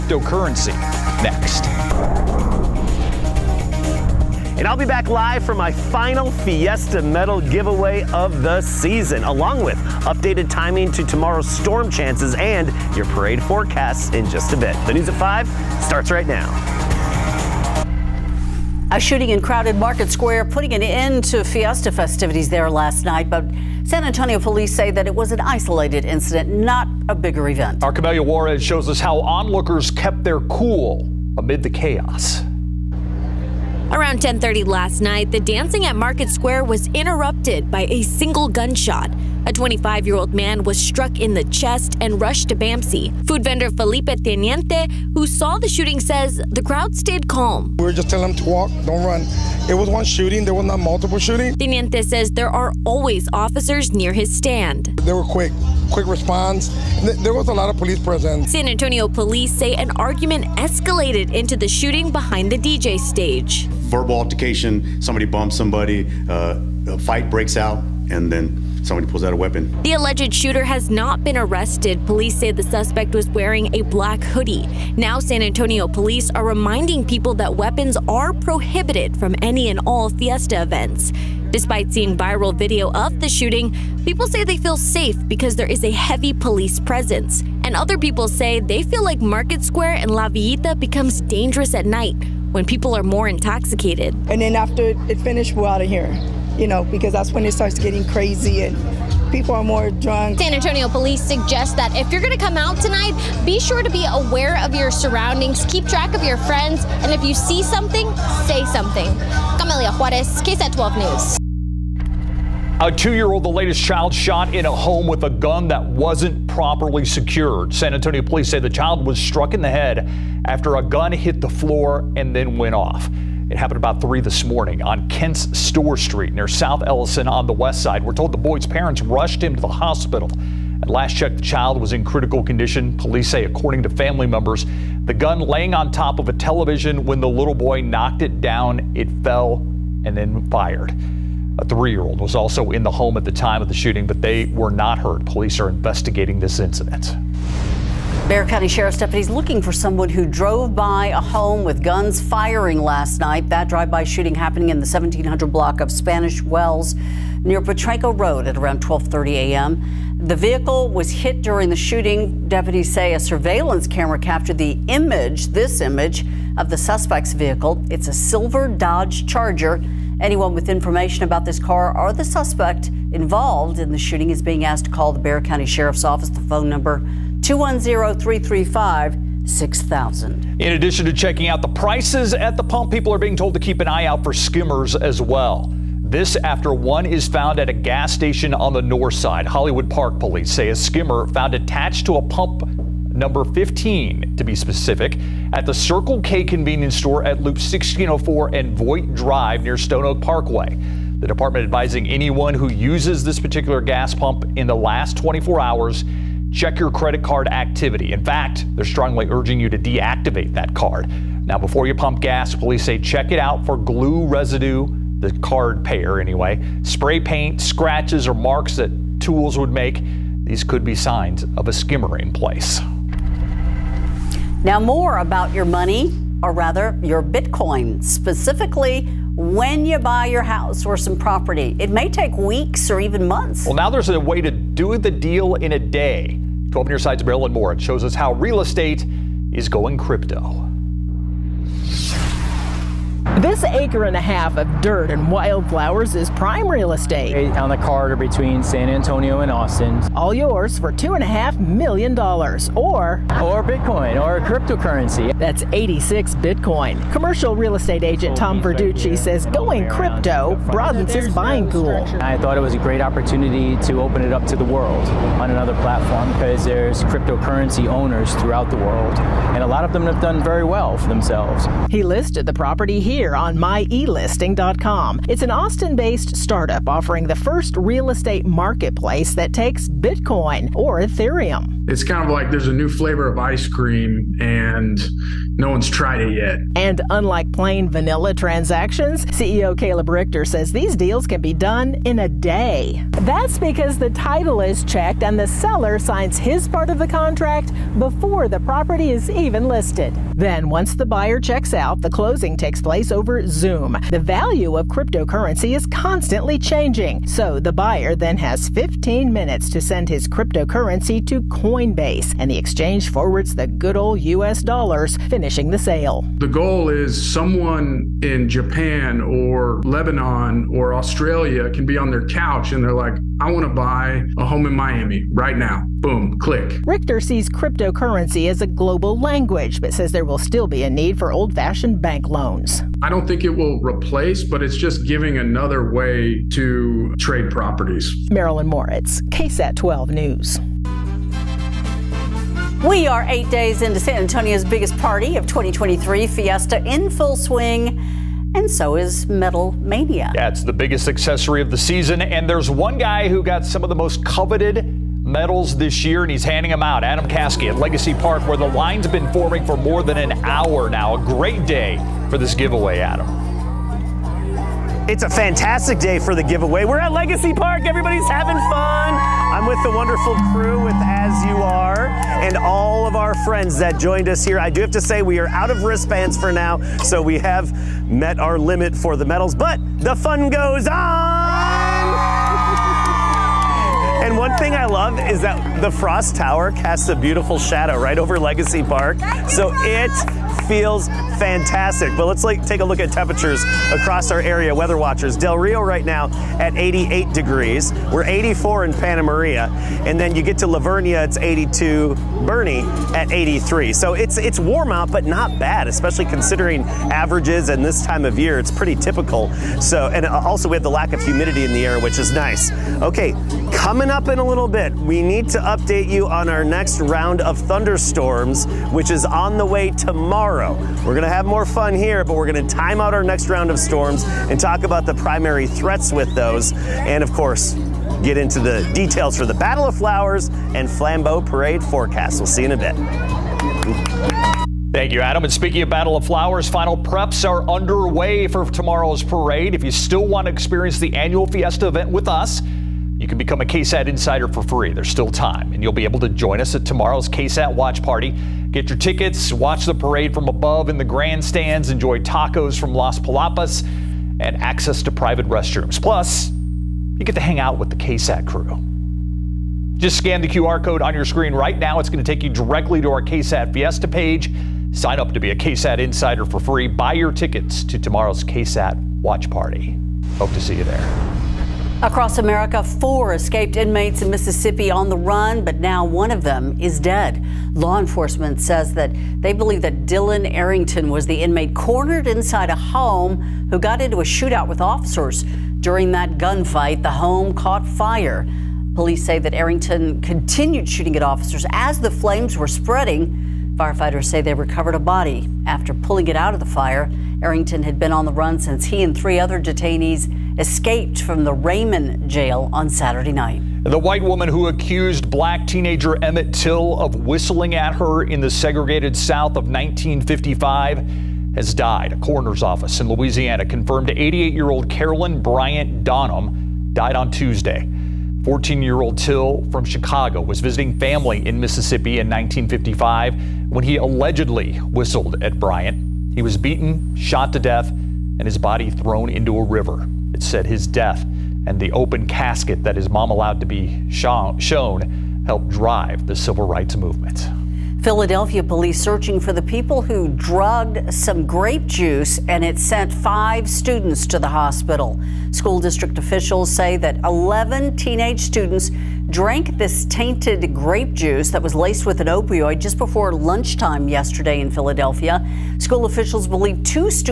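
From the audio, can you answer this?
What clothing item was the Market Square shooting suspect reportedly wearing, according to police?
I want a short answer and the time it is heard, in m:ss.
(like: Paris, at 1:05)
Black hoodie, at 1:13.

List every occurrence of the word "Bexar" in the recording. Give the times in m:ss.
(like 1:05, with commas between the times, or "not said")
2:28, 2:55.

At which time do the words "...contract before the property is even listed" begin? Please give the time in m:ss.
4:57.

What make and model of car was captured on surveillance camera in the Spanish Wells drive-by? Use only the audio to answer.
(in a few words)
Dodge Charger.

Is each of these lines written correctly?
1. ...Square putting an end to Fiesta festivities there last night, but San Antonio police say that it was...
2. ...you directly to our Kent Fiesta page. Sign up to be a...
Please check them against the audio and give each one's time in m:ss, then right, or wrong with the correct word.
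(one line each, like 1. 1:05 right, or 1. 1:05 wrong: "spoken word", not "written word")
1. 0:20 right
2. 7:42 wrong: "KSAT", not "Kent".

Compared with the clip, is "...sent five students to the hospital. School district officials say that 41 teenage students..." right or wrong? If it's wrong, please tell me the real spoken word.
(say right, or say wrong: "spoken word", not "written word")
wrong: "11", not "41".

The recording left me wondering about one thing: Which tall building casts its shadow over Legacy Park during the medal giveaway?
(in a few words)
Frost Tower.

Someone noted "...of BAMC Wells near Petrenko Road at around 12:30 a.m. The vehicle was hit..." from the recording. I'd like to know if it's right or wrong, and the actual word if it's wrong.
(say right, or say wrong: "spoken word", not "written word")
wrong: "Spanish", not "BAMC".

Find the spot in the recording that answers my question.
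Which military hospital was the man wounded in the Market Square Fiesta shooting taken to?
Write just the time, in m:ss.
0:42.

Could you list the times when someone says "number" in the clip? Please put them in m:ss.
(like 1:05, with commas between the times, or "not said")
2:56, 3:13.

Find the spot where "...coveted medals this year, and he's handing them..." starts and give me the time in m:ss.
5:54.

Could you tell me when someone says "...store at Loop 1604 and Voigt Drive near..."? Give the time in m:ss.
3:16.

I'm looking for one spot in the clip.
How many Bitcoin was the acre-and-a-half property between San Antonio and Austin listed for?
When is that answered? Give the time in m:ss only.
4:15.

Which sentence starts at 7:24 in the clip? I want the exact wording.
There's still time, and you'll be able to join us at tomorrow's KSAT watch party.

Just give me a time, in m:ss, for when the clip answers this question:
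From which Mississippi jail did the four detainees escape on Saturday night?
8:21.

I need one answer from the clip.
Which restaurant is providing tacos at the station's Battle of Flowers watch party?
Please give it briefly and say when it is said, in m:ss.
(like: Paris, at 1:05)
Las Palapas, at 7:32.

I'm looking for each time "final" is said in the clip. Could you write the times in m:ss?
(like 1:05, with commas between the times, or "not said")
0:05, 7:16.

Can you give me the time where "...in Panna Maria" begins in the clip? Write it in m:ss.
6:38.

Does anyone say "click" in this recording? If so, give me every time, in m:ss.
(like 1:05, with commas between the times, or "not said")
5:26.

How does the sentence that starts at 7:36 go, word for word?
Plus, you get to hang out with the KSAT crew.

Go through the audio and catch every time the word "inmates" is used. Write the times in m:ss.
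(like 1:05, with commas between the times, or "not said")
7:53, 8:01.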